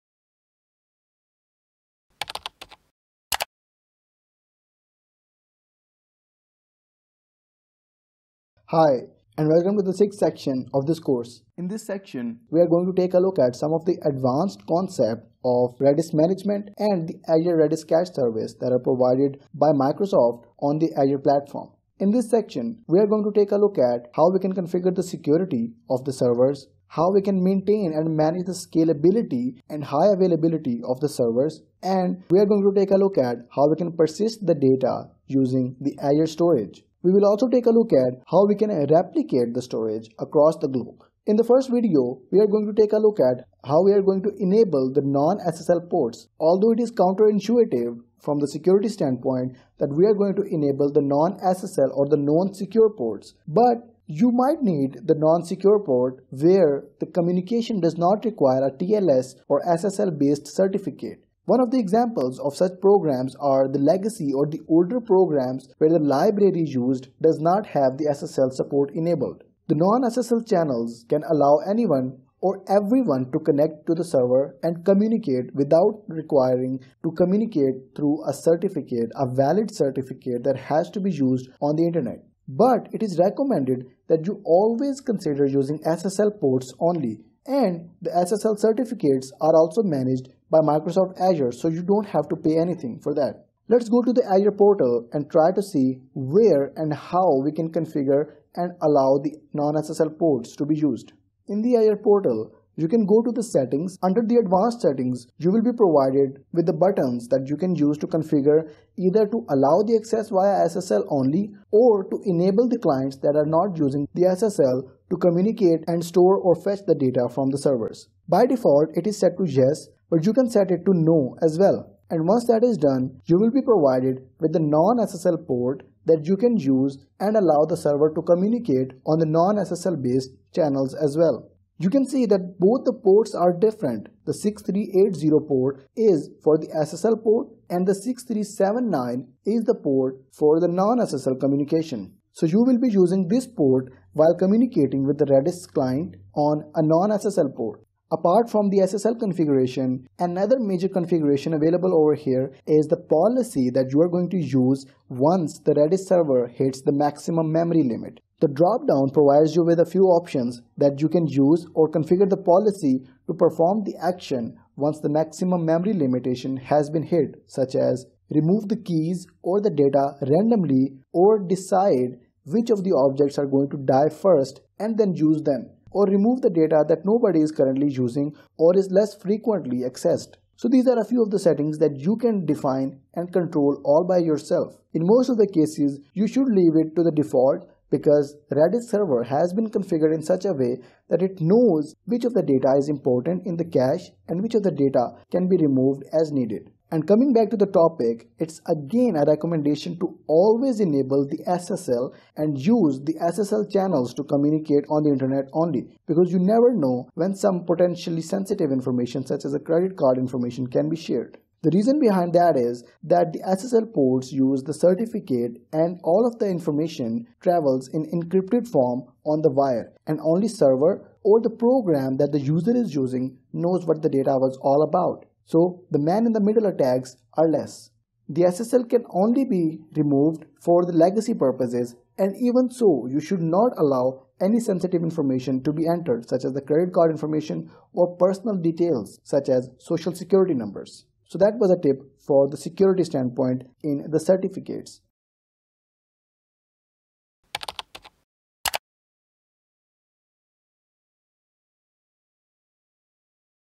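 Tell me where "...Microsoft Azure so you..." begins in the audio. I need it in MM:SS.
01:30.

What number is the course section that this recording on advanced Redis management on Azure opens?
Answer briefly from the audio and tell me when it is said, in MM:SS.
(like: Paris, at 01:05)
sixth, at 00:09.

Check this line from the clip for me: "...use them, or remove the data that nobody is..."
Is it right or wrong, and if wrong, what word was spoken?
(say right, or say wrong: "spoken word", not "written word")
right.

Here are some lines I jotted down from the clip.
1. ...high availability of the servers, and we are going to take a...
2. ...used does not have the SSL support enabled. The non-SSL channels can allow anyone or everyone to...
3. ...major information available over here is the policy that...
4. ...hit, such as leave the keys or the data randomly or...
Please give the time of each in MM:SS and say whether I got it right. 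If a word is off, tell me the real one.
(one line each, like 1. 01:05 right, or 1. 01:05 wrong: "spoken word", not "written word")
1. 00:29 right
2. 01:06 right
3. 02:30 wrong: "configuration", not "information"
4. 02:47 wrong: "remove", not "leave".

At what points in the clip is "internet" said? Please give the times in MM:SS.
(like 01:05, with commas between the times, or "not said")
01:21, 03:25.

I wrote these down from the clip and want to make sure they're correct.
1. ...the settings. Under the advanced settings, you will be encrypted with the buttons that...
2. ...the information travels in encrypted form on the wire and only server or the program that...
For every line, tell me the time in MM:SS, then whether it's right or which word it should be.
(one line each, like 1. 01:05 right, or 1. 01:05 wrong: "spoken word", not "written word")
1. 01:43 wrong: "provided", not "encrypted"
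2. 03:36 right.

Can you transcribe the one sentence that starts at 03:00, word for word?
So these are a few of the settings that you can define and control all by yourself.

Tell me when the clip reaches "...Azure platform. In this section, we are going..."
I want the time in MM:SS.
00:20.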